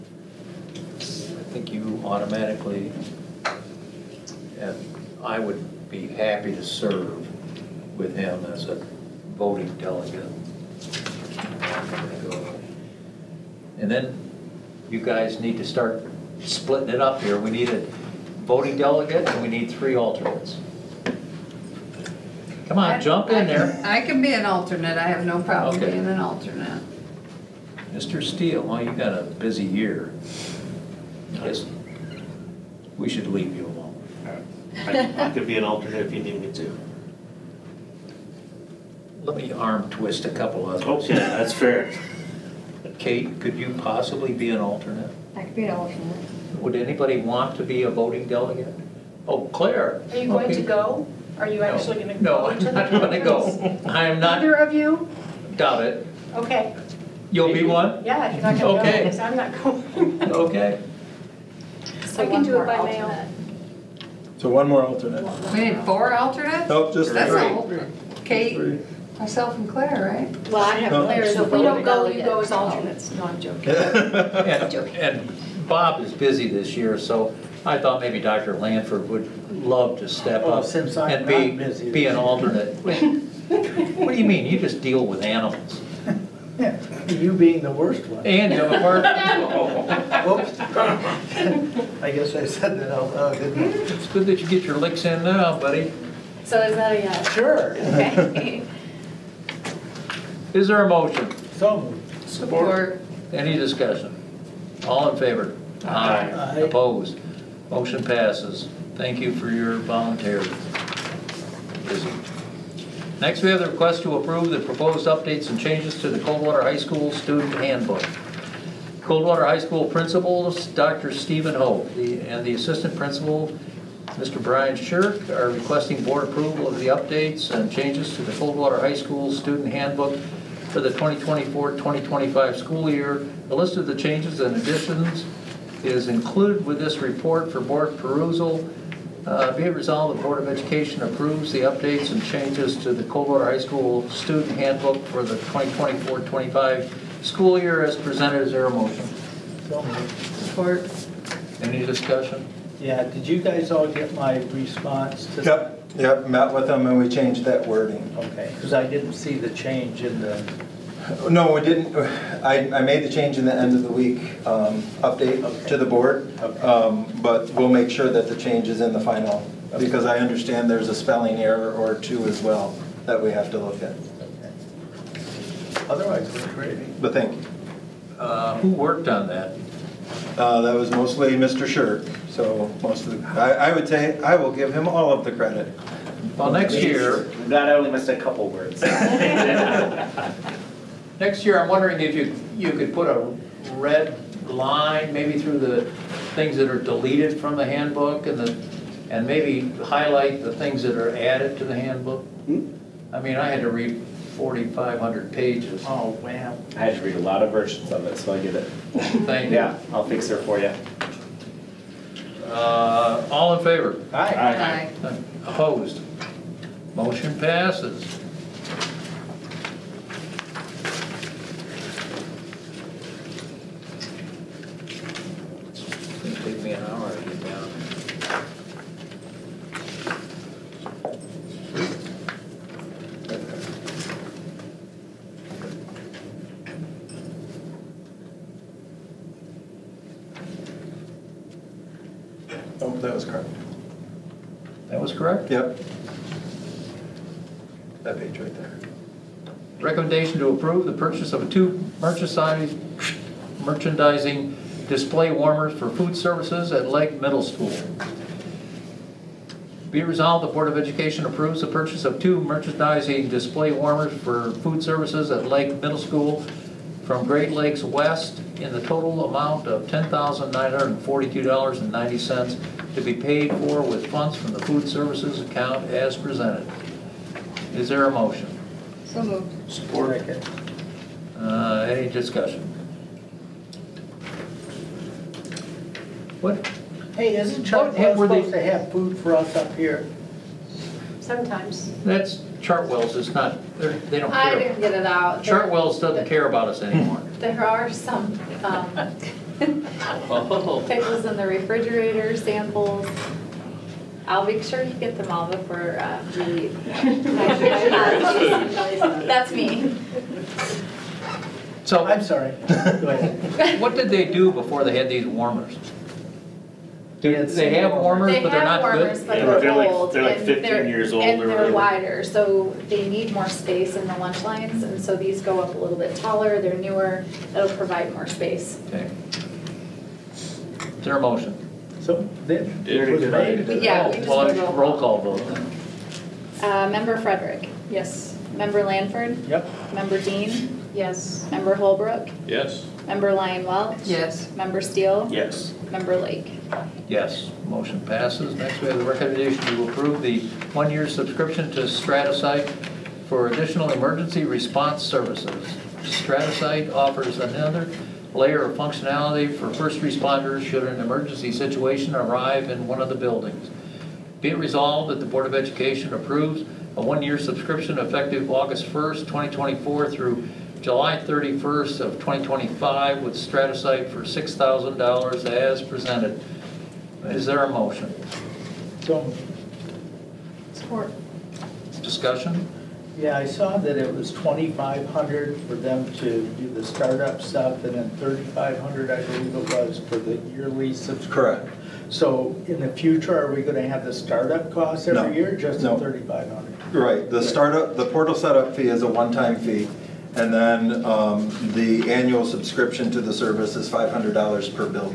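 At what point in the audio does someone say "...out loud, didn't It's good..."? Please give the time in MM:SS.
01:32.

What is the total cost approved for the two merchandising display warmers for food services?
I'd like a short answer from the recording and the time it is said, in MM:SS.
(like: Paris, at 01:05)
$10,942.90, at 04:29.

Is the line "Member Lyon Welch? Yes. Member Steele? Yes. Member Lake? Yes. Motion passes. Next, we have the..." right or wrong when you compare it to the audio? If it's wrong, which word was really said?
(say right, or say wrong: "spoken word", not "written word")
right.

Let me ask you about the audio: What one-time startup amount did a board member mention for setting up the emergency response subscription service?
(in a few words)
2,500.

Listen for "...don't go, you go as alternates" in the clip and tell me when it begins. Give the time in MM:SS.
01:11.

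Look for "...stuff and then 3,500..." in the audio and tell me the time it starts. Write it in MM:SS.
06:27.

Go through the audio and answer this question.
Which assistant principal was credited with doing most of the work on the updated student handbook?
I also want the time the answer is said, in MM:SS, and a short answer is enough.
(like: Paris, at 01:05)
Mr. Shirk, at 03:01.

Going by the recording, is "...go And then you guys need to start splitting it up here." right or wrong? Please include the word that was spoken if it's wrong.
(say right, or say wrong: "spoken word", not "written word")
right.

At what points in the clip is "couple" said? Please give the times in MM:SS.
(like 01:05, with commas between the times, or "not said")
00:40, 03:08.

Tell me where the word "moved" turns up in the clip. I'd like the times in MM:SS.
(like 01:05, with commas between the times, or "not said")
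01:41, 04:39.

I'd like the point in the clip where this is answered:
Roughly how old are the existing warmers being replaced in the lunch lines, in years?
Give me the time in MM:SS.
05:20.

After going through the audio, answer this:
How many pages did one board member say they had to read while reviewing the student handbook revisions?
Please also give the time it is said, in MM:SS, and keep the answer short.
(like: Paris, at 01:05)
4,500, at 03:24.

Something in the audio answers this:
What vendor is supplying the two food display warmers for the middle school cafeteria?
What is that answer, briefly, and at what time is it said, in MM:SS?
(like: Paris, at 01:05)
Great Lakes West, at 04:27.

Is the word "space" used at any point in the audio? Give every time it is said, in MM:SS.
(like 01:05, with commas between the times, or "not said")
05:23, 05:28.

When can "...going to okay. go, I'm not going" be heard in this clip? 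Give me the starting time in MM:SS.
00:58.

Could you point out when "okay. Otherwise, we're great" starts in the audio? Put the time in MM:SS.
02:53.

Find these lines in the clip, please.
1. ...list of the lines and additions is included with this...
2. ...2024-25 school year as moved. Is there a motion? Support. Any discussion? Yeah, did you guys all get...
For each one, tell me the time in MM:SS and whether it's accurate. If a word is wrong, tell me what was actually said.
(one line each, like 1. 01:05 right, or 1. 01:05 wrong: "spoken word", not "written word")
1. 02:13 wrong: "changes", not "lines"
2. 02:25 wrong: "presented", not "moved".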